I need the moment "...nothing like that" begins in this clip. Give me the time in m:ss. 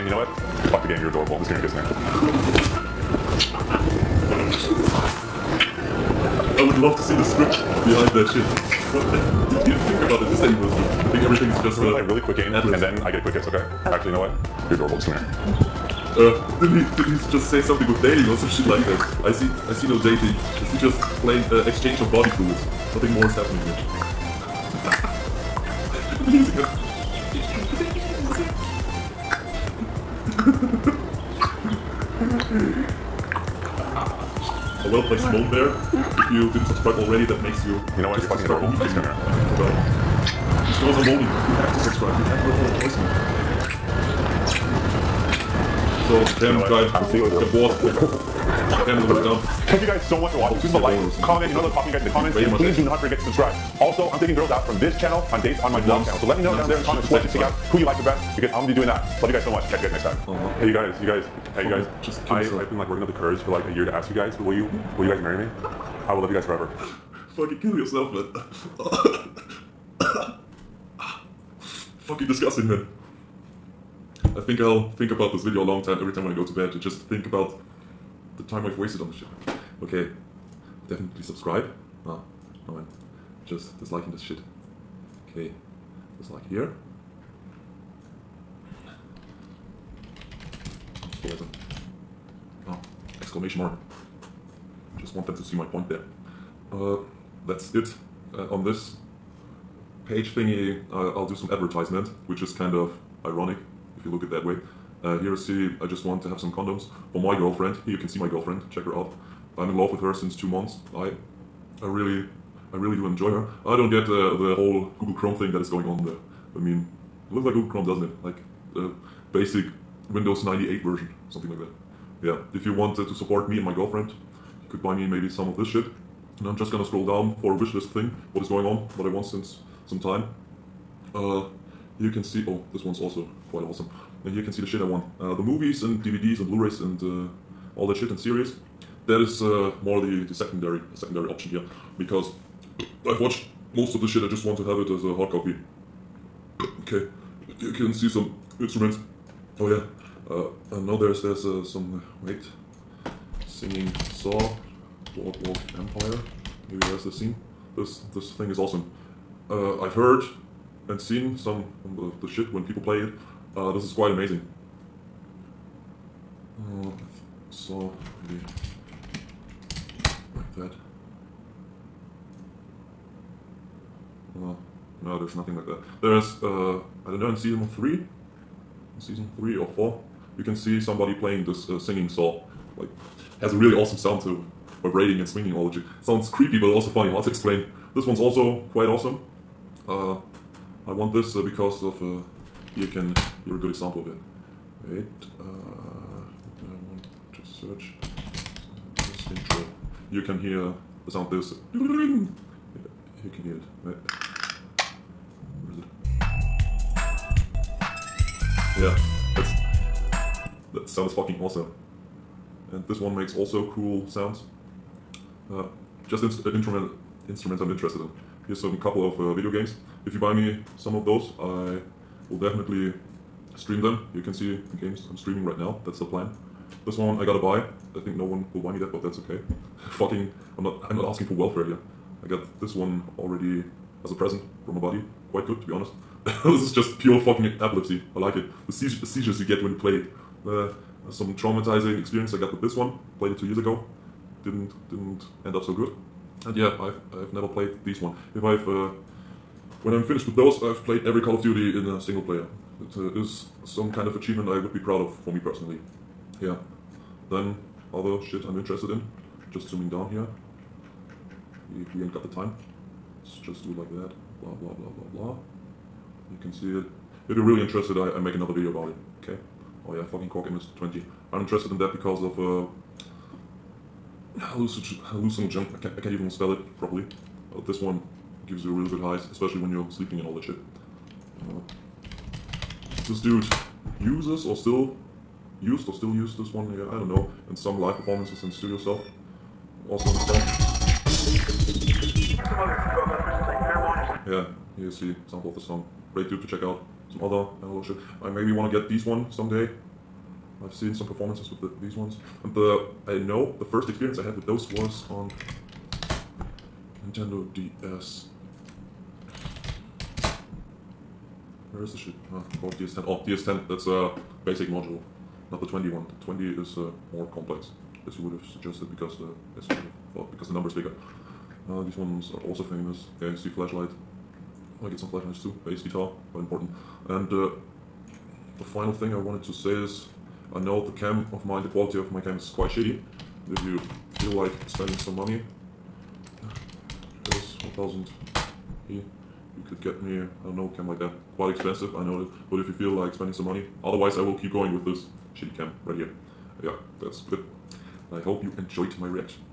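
2:55.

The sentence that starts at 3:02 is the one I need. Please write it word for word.
Like, has a really awesome sound to vibrating and swinging all the Sounds creepy, but also funny, hard to explain.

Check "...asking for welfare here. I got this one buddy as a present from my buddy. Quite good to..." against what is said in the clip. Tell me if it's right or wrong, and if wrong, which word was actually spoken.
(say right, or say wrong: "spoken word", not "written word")
wrong: "already", not "buddy".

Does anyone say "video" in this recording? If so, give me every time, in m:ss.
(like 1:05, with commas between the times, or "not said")
1:15, 3:39, 4:28.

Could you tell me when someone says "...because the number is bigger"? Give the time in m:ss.
5:20.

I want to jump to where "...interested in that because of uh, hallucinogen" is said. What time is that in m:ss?
4:31.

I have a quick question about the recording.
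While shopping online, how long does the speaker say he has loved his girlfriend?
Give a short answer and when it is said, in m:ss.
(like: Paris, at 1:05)
2 months, at 1:50.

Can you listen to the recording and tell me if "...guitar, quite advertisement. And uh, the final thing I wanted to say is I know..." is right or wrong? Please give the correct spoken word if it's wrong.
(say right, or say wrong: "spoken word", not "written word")
wrong: "important", not "advertisement".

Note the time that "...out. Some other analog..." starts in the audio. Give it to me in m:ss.
4:56.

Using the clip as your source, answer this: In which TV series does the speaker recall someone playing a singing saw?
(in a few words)
Boardwalk Empire.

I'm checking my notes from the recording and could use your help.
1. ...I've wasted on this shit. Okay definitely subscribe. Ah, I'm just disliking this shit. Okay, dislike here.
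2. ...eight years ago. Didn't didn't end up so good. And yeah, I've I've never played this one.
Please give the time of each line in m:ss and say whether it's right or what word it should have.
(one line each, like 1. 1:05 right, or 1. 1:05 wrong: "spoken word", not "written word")
1. 1:18 right
2. 4:03 wrong: "two", not "eight".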